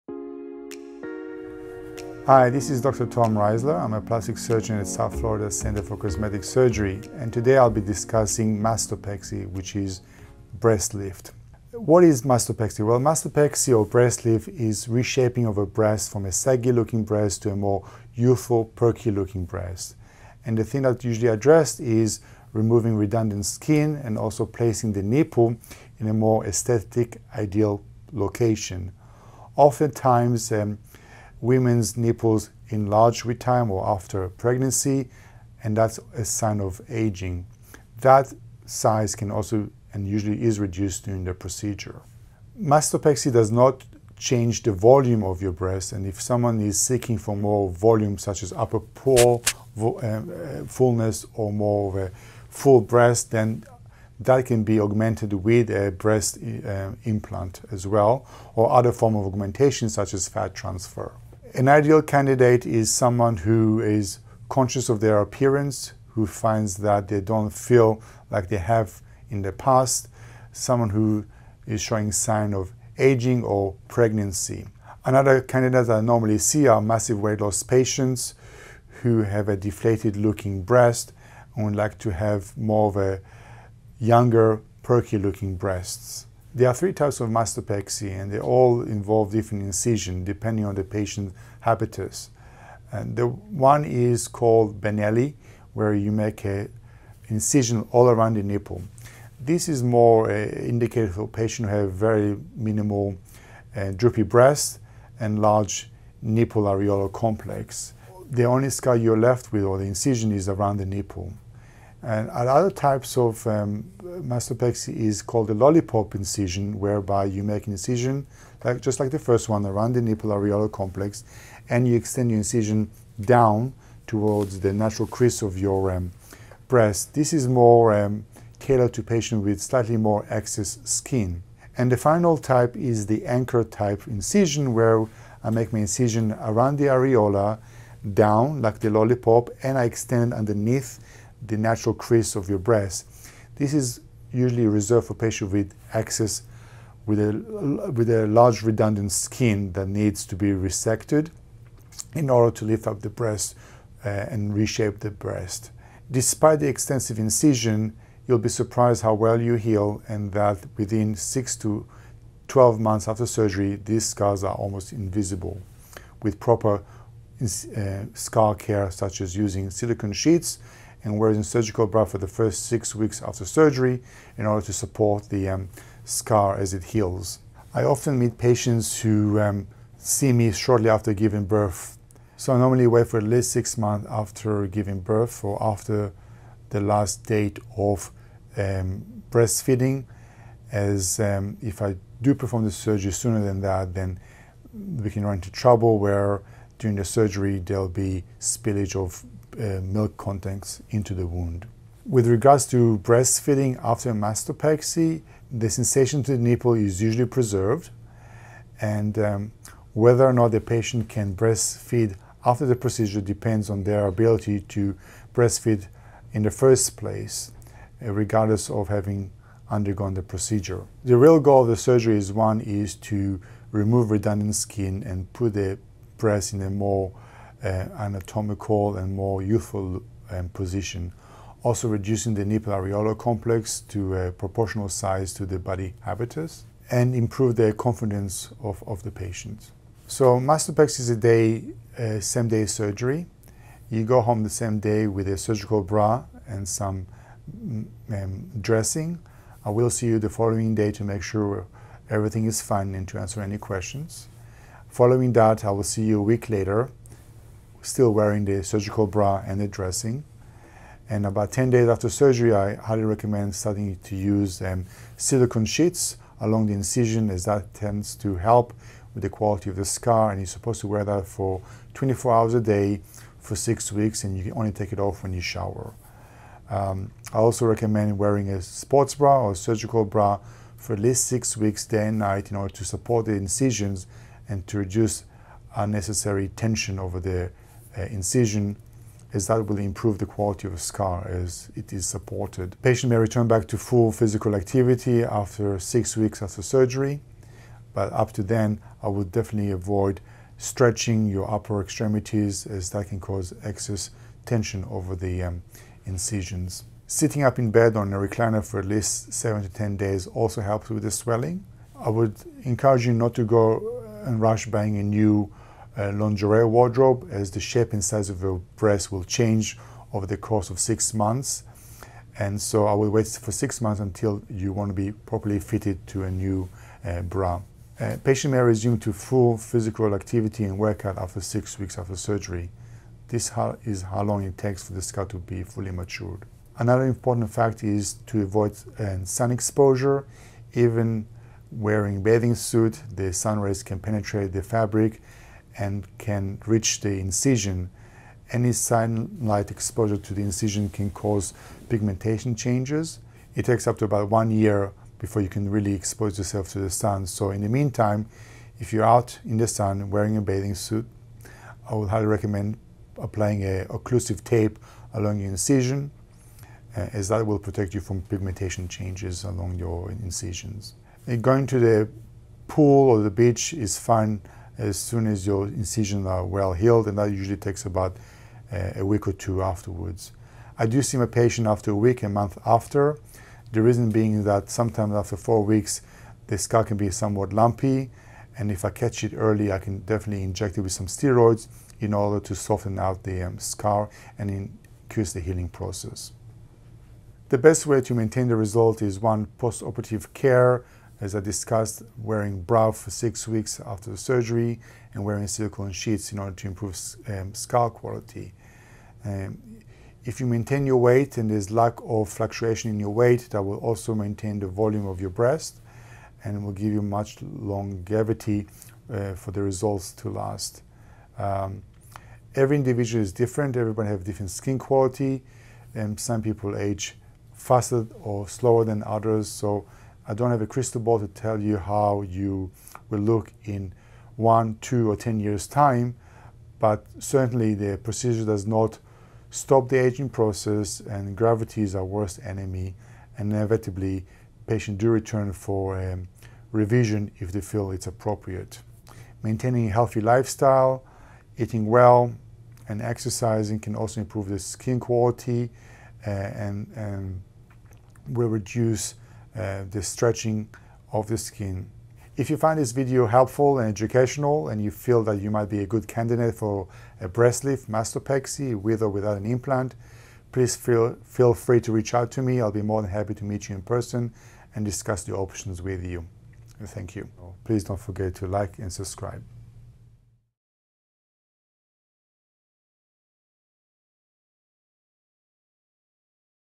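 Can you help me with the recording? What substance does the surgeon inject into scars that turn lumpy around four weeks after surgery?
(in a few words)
steroids.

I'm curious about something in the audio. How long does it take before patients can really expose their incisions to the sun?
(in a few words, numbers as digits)
about 1 year.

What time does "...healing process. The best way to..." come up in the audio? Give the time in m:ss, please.
6:35.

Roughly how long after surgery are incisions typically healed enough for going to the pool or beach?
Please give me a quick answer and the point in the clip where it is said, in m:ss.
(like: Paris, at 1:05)
a week or two, at 6:18.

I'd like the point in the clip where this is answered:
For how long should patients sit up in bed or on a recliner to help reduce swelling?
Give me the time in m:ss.
5:09.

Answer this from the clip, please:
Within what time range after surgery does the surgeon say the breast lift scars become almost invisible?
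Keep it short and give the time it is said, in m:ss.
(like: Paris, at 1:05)
6 to 12 months, at 2:41.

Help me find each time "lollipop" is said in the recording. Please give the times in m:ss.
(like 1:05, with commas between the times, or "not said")
1:55, 2:18.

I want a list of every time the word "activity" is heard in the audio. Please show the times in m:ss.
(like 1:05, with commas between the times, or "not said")
4:54, 5:30.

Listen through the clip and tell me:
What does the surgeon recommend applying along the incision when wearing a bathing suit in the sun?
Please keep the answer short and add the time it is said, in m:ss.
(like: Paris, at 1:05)
occlusive tape, at 6:03.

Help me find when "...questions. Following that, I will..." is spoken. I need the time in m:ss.
4:13.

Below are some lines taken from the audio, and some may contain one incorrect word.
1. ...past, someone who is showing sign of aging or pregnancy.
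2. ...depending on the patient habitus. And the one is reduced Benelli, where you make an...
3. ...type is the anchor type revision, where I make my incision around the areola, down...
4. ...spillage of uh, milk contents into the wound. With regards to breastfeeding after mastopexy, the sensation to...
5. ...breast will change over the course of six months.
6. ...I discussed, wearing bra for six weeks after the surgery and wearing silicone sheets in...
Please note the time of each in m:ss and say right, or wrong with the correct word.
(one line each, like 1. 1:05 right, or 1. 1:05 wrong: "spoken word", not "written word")
1. 1:09 right
2. 1:30 wrong: "called", not "reduced"
3. 2:12 wrong: "incision", not "revision"
4. 3:18 right
5. 5:18 right
6. 6:41 right.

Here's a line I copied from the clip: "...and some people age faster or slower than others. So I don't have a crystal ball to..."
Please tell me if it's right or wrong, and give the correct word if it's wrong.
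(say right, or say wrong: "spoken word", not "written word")
right.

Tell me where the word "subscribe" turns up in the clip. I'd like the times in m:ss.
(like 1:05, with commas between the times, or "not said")
7:58.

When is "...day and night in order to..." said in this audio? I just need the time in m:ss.
4:41.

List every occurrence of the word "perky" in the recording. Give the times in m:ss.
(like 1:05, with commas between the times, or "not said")
0:18, 1:24.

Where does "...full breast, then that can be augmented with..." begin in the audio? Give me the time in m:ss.
0:52.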